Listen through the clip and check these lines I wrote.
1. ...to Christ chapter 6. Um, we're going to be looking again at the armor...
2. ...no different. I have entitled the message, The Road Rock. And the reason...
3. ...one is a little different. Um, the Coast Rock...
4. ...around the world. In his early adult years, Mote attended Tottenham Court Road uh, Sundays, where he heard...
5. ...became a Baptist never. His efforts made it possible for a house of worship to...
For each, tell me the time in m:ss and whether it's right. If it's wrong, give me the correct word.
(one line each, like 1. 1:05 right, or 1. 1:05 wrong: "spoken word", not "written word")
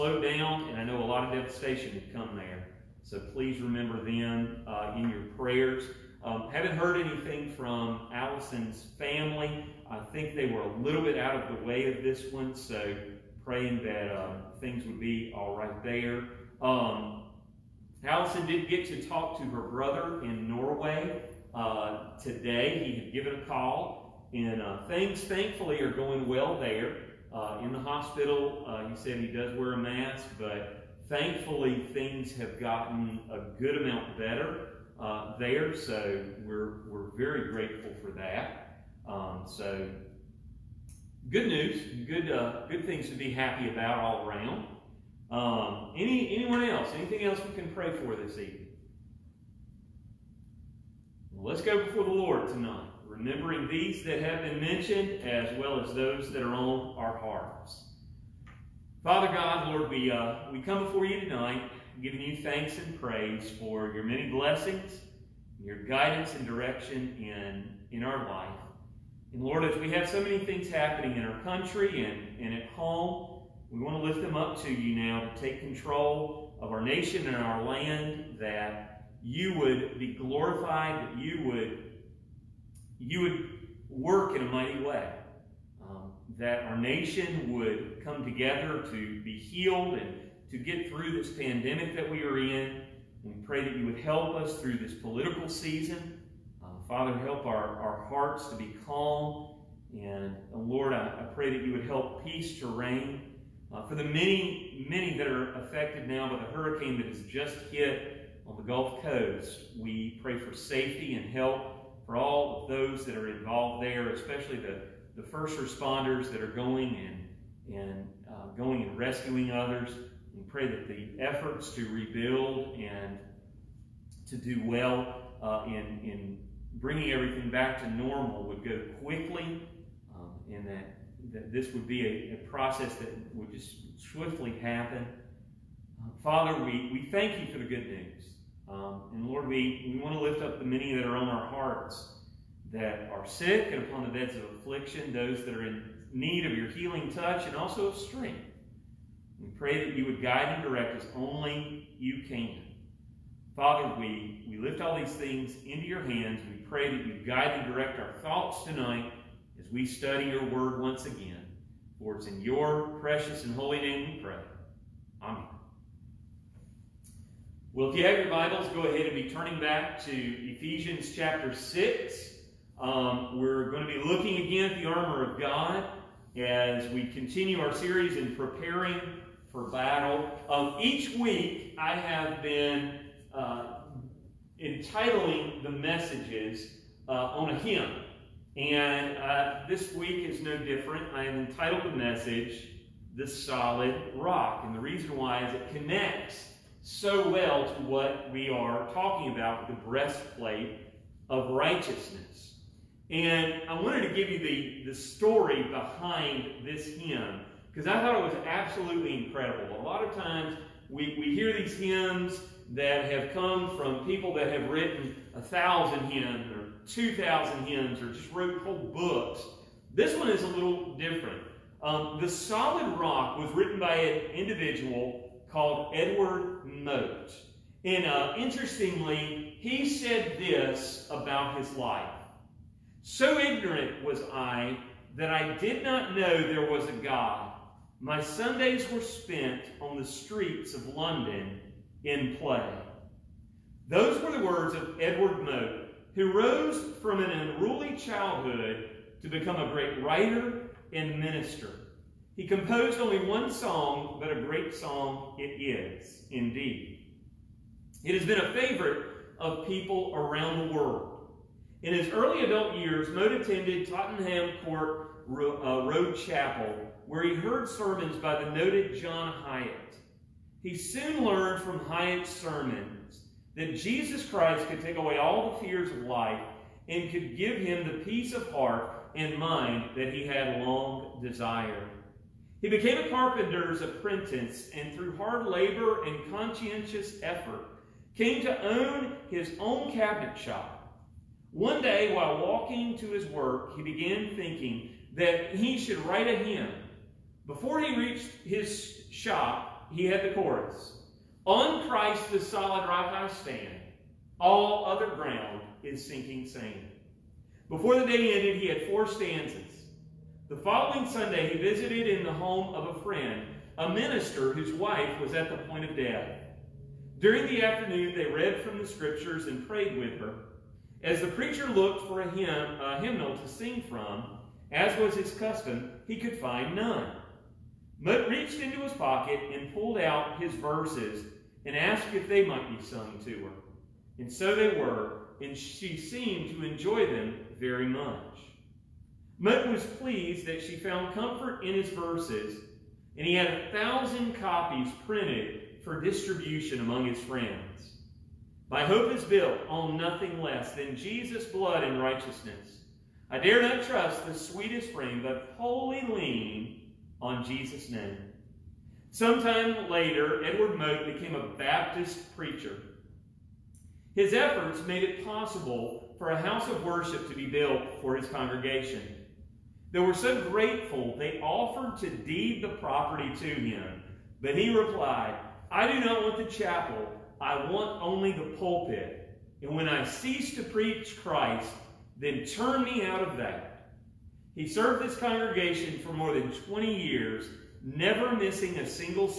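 1. 2:50 wrong: "Ephesians", not "Christ"
2. 3:10 wrong: "Solid", not "Road"
3. 3:40 wrong: "Solid", not "Coast"
4. 4:20 wrong: "Chapel", not "Sundays"
5. 6:01 wrong: "preacher", not "never".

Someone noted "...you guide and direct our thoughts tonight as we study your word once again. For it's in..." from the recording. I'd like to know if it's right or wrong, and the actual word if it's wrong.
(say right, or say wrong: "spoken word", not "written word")
right.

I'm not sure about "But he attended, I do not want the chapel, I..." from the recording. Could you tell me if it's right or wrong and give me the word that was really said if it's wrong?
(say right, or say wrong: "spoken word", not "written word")
wrong: "replied", not "attended".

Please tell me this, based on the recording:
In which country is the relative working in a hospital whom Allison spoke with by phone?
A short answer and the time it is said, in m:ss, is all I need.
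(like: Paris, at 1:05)
Norway, at 0:20.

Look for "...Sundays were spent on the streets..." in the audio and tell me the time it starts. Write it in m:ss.
3:58.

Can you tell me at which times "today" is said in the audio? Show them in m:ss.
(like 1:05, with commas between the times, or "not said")
0:22.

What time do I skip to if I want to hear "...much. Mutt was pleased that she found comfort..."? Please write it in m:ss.
5:37.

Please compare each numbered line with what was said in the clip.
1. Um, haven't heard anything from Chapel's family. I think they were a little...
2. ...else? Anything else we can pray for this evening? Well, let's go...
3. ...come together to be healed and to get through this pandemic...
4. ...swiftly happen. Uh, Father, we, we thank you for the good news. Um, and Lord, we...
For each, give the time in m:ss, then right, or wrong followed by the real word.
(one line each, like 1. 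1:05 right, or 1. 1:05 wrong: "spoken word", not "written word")
1. 0:06 wrong: "Allison", not "Chapel"
2. 0:46 right
3. 1:28 right
4. 2:14 right.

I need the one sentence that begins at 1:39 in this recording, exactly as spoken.
And Lord, I, I, pray that you would help peace to reign.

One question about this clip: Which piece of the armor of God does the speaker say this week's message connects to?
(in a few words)
breastplate of righteousness.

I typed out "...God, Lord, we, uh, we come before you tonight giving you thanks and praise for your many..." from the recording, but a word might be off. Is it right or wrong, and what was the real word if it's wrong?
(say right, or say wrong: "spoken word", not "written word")
right.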